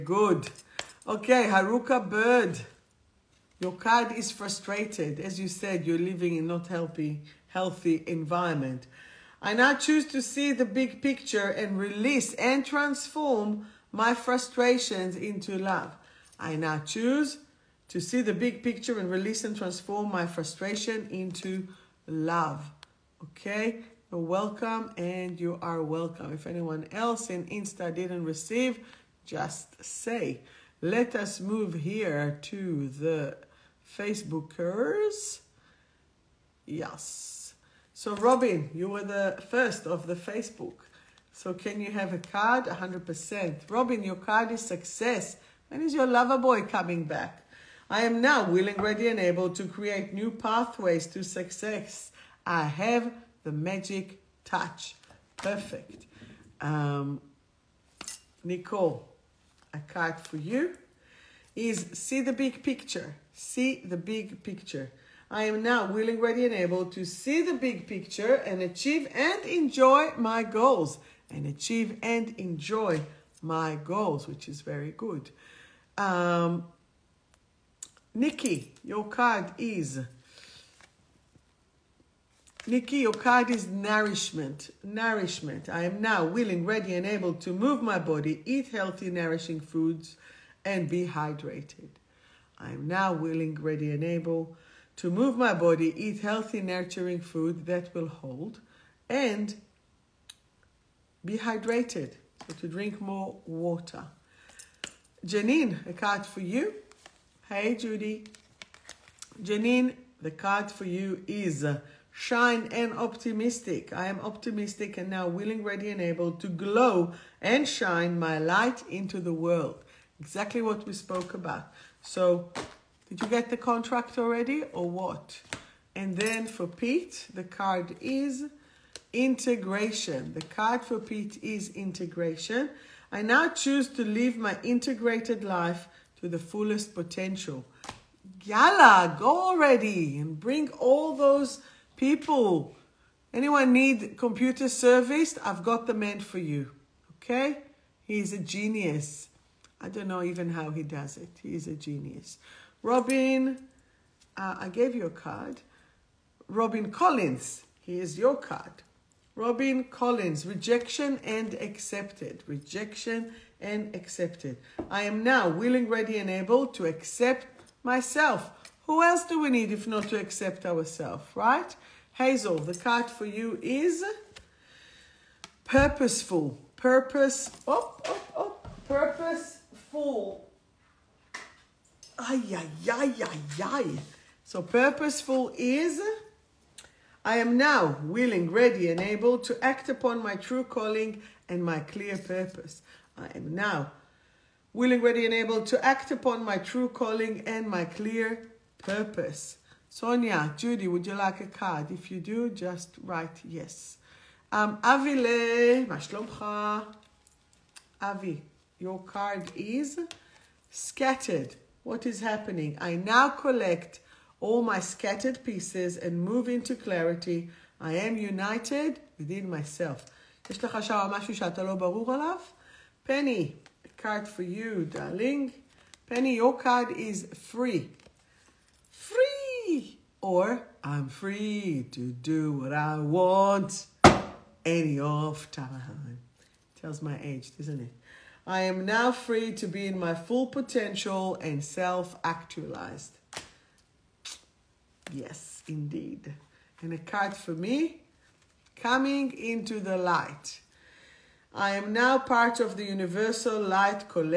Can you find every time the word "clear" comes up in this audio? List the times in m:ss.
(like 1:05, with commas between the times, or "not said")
3:11, 3:17.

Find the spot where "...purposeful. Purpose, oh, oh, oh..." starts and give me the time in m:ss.
2:55.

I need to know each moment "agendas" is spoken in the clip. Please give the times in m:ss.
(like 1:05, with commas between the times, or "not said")
not said.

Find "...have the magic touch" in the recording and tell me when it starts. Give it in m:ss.
0:52.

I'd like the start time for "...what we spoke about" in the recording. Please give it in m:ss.
2:00.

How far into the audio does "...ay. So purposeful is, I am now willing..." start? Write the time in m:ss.
3:03.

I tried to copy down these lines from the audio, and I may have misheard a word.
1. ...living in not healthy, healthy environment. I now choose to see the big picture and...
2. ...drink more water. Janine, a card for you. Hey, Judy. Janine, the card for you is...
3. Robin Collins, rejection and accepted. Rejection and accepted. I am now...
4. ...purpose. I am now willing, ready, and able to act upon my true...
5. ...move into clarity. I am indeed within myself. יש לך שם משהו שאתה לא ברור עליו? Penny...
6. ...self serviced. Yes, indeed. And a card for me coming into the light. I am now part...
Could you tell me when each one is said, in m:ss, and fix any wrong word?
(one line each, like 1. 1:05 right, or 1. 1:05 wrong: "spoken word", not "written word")
1. 0:05 right
2. 1:42 right
3. 2:39 right
4. 3:12 right
5. 3:36 wrong: "united", not "indeed"
6. 4:01 wrong: "actualized", not "serviced".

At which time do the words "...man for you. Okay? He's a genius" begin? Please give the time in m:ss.
2:25.